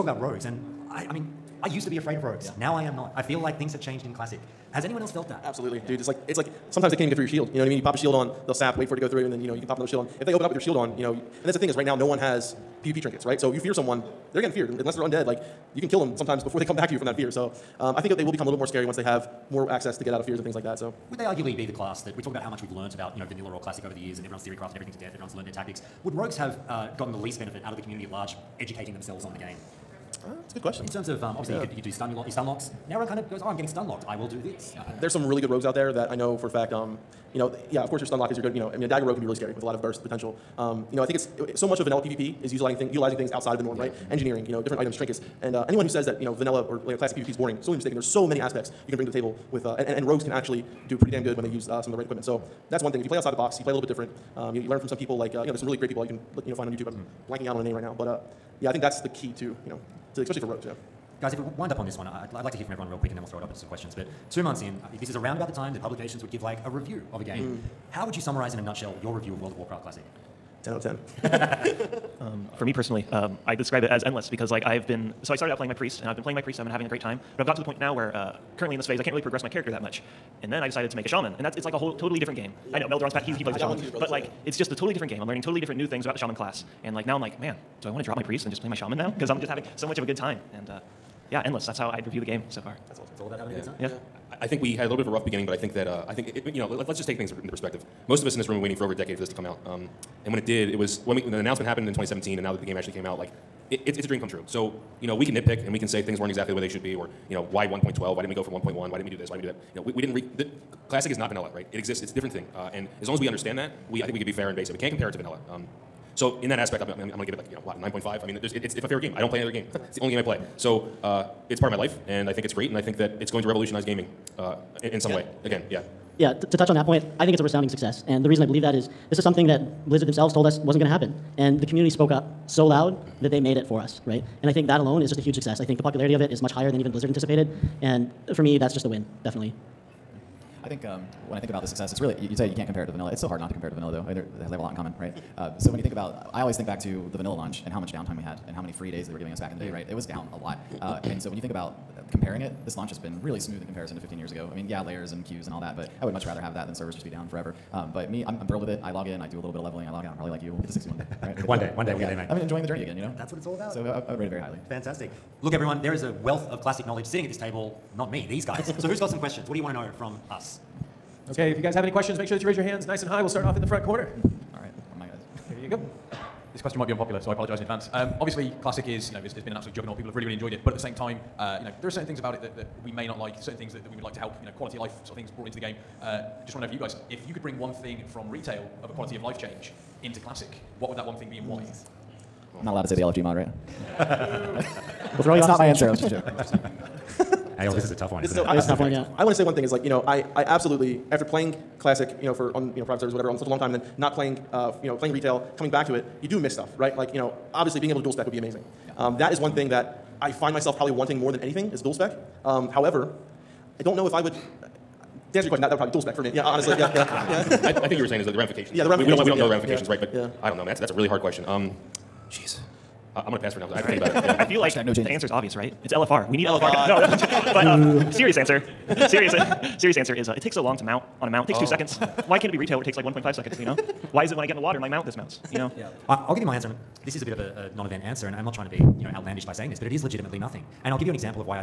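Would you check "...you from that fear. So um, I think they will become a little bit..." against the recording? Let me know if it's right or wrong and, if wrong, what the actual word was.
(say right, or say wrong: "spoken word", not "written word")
right.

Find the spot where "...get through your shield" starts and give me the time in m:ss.
0:07.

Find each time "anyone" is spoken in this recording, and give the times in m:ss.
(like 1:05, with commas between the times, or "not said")
0:04, 0:45.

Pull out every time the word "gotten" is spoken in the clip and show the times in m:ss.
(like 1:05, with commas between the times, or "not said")
0:26, 1:17.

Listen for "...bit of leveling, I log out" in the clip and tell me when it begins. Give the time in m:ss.
2:39.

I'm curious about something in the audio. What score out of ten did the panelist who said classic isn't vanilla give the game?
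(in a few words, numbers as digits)
9.5.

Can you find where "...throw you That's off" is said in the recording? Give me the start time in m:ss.
3:15.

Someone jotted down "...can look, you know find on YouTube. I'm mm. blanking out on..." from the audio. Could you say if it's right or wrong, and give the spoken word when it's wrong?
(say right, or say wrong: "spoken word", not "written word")
right.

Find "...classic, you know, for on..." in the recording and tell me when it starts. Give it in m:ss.
3:21.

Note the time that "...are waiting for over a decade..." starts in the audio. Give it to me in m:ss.
1:38.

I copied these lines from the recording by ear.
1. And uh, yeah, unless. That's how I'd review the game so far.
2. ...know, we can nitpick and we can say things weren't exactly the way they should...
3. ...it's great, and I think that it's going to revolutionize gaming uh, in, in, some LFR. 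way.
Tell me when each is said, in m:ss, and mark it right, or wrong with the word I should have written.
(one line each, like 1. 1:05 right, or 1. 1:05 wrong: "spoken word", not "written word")
1. 1:30 wrong: "endless", not "unless"
2. 1:45 right
3. 2:02 wrong: "Again", not "LFR".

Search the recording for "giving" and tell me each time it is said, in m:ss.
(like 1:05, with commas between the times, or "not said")
2:29.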